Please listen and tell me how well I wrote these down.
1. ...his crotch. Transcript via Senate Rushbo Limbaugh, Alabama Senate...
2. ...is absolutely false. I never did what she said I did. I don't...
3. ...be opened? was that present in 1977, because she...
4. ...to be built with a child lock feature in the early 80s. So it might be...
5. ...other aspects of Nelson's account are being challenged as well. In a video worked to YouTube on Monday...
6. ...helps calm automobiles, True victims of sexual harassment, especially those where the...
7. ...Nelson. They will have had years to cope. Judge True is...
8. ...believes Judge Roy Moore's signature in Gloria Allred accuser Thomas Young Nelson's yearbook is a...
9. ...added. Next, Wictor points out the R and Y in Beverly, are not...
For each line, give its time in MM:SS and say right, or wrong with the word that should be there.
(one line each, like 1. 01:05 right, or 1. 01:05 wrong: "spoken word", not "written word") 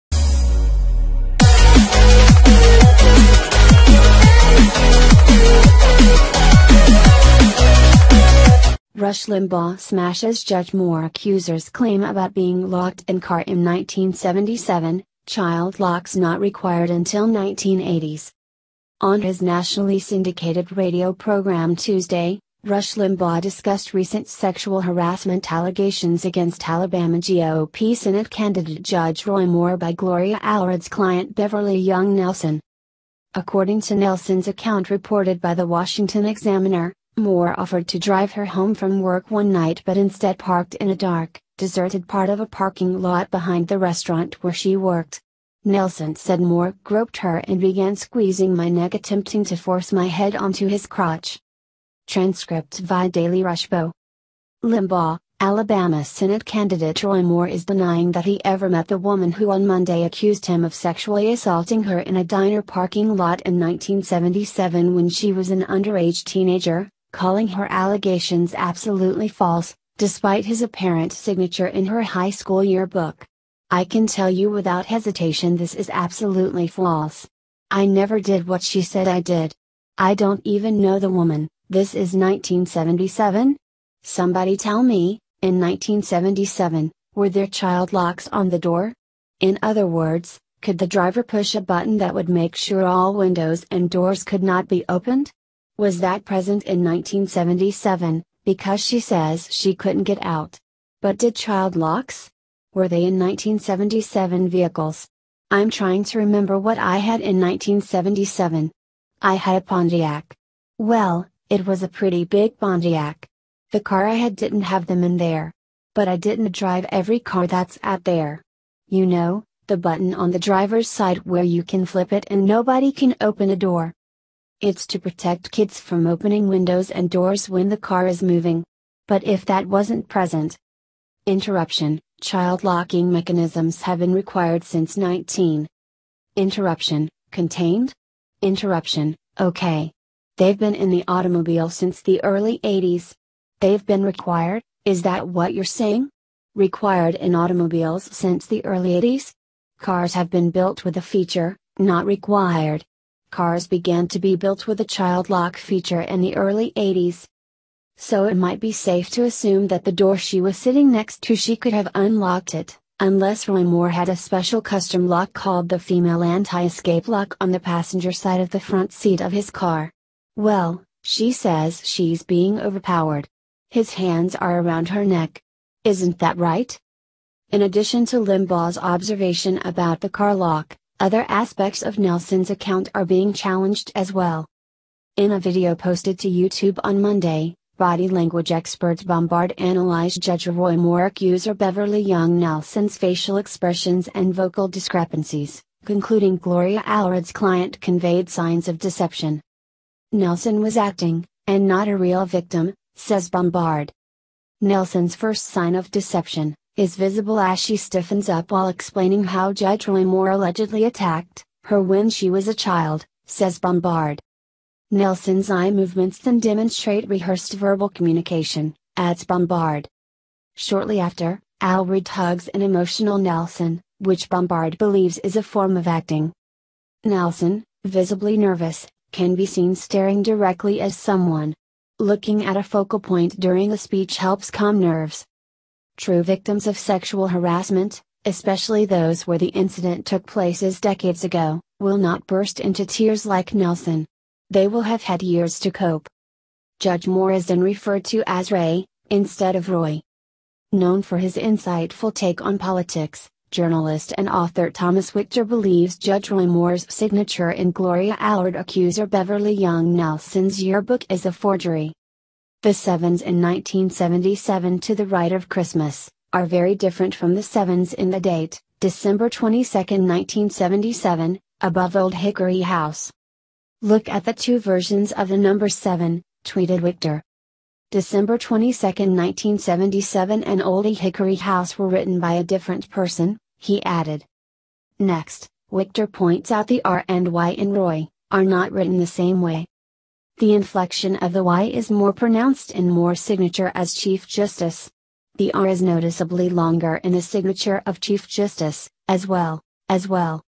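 1. 00:50 wrong: "Daily", not "Senate"
2. 01:15 right
3. 01:34 right
4. 02:34 right
5. 03:01 wrong: "posted", not "worked"
6. 03:54 wrong: "nerves", not "automobiles"
7. 04:03 wrong: "Moore", not "True"
8. 04:15 wrong: "Beverly", not "Thomas"
9. 04:43 wrong: "Roy", not "Beverly".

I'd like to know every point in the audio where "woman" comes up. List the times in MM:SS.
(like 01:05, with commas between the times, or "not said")
00:58, 01:21.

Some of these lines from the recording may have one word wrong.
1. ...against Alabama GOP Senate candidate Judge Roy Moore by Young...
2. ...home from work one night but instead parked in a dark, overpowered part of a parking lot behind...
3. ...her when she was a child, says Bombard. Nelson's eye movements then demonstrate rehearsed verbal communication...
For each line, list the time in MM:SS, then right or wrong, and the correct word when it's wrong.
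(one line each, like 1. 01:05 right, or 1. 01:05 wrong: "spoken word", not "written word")
1. 00:26 wrong: "Gloria", not "Young"
2. 00:38 wrong: "deserted", not "overpowered"
3. 03:31 right.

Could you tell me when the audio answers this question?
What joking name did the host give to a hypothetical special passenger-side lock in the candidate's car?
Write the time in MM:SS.
02:45.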